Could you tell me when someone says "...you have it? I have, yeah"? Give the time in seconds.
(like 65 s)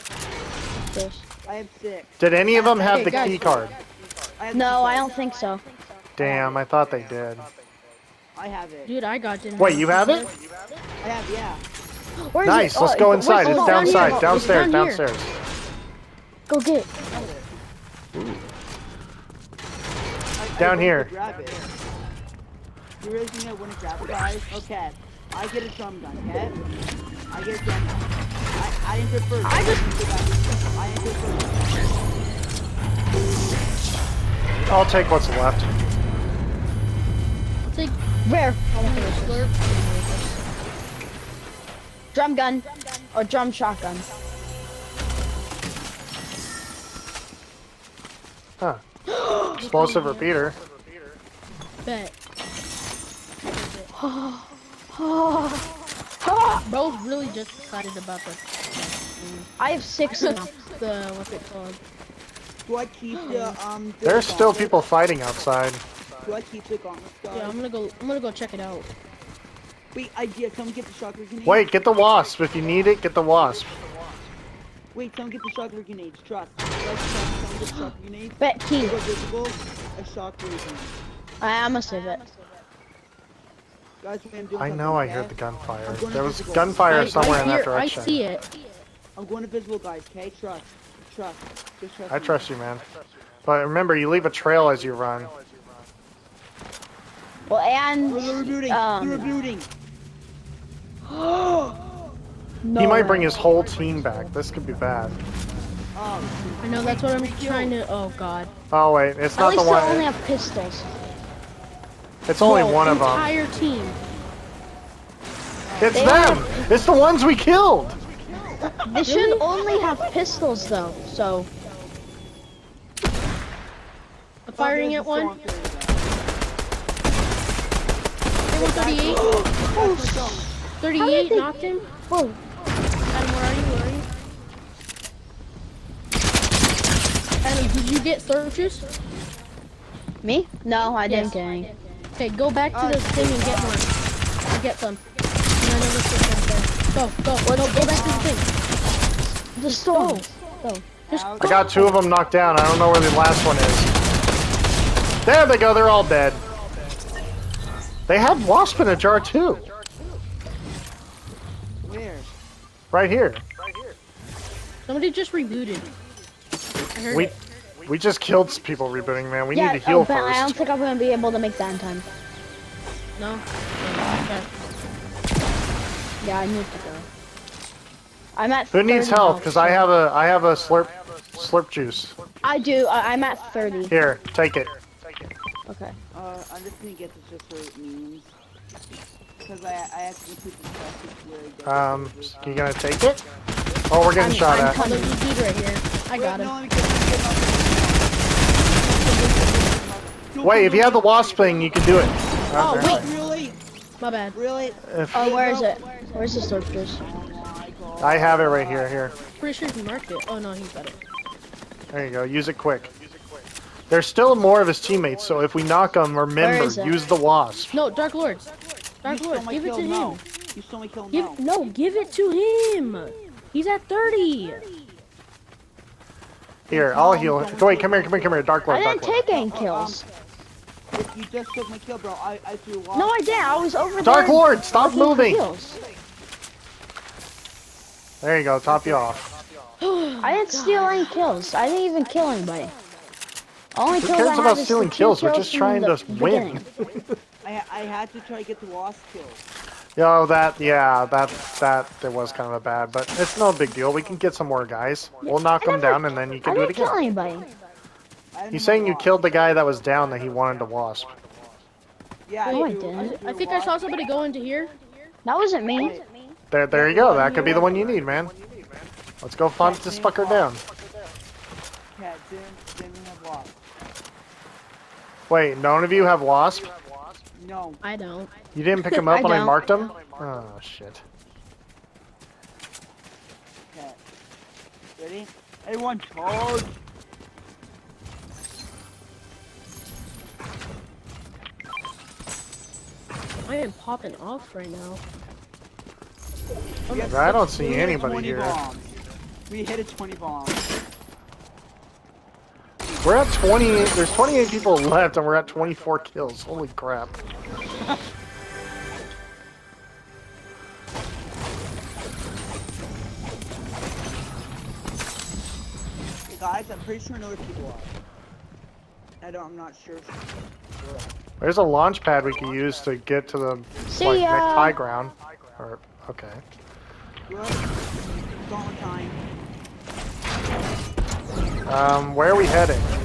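9 s.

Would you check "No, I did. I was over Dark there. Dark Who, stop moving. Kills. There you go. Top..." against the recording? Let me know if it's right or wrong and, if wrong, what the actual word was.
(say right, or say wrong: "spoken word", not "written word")
wrong: "Lord", not "Who".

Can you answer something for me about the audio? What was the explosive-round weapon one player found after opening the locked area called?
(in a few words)
Explosive repeater.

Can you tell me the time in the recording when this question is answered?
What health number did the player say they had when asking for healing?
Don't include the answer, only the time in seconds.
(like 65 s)
182 s.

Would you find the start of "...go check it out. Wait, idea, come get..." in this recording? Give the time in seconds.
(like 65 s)
68 s.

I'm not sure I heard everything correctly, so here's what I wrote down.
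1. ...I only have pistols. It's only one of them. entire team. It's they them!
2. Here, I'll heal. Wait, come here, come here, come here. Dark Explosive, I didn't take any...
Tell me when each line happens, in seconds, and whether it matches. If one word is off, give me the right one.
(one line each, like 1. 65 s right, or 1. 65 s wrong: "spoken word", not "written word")
1. 109 s right
2. 226 s wrong: "Lord", not "Explosive".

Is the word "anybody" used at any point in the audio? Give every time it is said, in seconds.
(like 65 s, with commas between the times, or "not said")
242 s, 257 s, 297 s.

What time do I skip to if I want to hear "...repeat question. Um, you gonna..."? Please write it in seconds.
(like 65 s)
190 s.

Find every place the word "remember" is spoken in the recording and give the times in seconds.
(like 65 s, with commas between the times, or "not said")
93 s, 216 s.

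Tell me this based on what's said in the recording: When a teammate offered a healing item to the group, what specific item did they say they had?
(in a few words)
Slurp juice.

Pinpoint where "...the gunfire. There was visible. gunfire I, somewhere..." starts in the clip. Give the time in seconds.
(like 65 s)
85 s.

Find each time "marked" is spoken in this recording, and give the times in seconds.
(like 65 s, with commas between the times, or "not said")
209 s, 279 s.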